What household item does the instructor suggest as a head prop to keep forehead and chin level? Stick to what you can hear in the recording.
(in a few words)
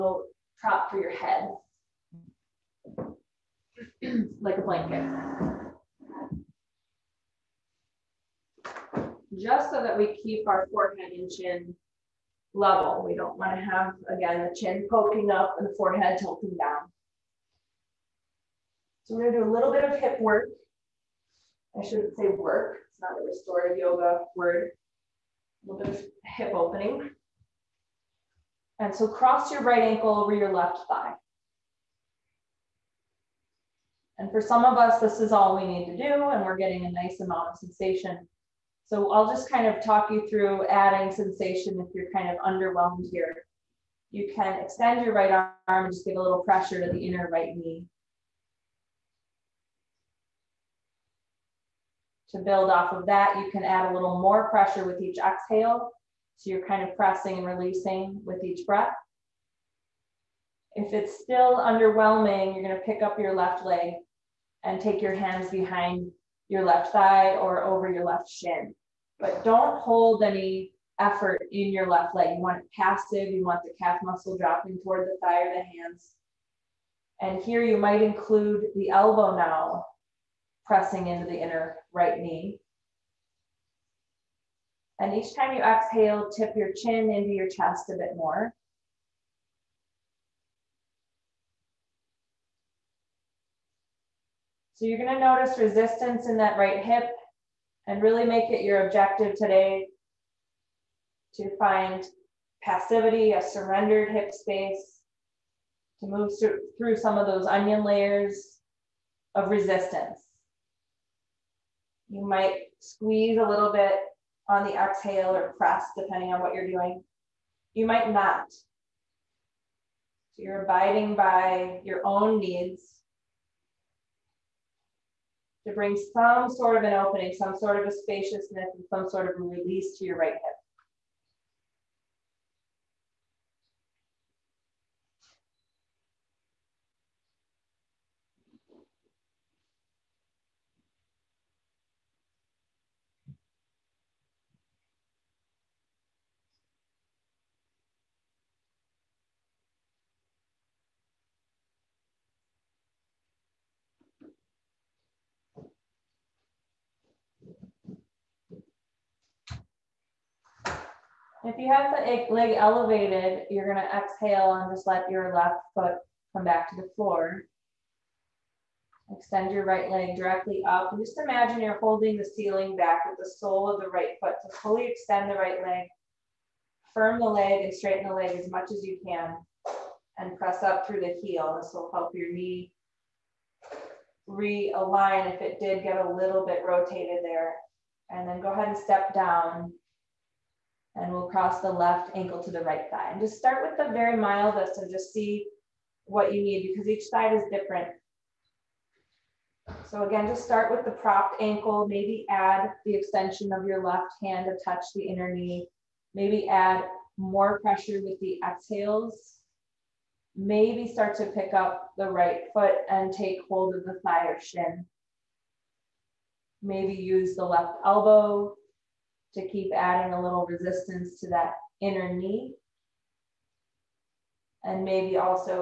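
a blanket.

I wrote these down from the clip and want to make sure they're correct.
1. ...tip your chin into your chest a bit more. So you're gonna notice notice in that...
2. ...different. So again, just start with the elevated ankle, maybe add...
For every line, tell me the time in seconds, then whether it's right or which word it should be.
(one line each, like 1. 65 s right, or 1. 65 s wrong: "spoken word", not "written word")
1. 86 s wrong: "resistance", not "notice"
2. 197 s wrong: "propped", not "elevated".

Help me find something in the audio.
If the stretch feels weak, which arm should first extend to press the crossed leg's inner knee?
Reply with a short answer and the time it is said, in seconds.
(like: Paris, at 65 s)
right arm, at 45 s.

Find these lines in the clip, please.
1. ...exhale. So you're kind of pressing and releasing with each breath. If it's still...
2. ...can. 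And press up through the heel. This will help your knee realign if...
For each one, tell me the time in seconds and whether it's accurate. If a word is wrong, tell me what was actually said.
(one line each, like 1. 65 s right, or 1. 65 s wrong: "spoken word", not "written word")
1. 55 s right
2. 179 s right.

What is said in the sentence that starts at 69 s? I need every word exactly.
But don't hold any effort in your left leg.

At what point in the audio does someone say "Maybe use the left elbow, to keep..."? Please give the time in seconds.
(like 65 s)
216 s.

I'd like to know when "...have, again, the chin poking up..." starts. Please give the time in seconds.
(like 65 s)
13 s.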